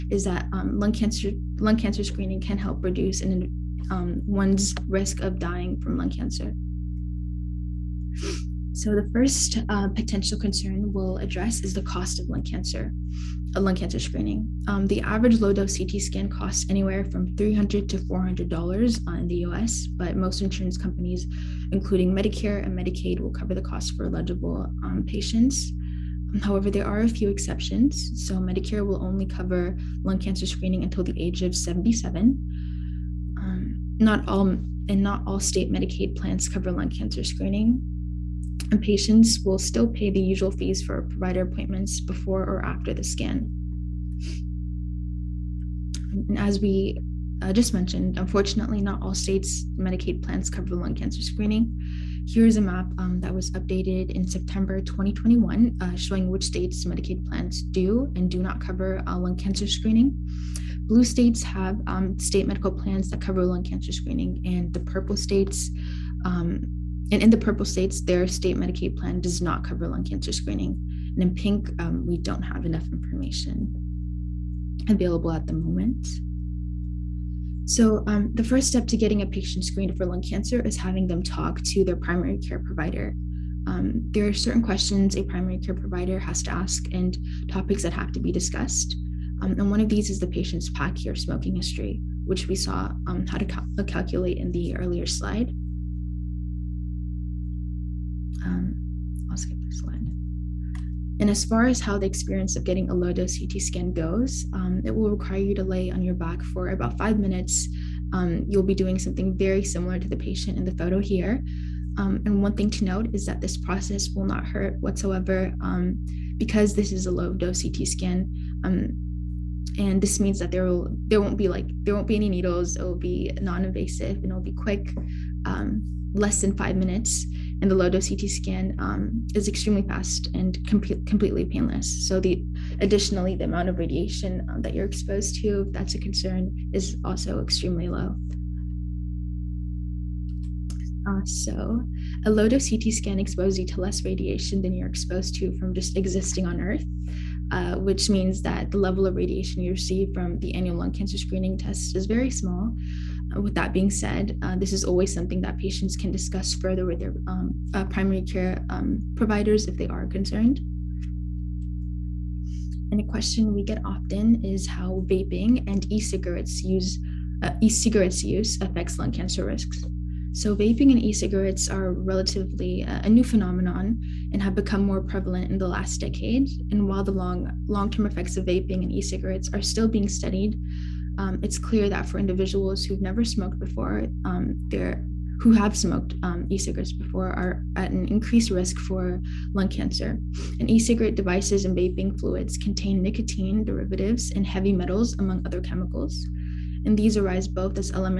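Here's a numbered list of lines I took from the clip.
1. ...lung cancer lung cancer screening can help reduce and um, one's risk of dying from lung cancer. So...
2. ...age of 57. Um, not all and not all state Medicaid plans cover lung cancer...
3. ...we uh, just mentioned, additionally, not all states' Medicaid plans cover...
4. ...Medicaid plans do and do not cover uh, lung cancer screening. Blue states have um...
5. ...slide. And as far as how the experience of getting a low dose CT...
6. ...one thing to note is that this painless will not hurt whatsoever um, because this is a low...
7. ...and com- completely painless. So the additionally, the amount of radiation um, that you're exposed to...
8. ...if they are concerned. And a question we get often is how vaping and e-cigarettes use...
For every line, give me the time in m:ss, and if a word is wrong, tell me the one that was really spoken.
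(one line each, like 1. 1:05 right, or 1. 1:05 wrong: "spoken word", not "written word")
1. 0:00 right
2. 0:31 wrong: "77", not "57"
3. 0:46 wrong: "unfortunately", not "additionally"
4. 0:56 right
5. 1:39 right
6. 1:52 wrong: "process", not "painless"
7. 2:10 right
8. 2:39 right.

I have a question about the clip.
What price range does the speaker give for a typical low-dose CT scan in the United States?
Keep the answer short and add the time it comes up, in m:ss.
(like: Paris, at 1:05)
$300 to $400, at 0:17.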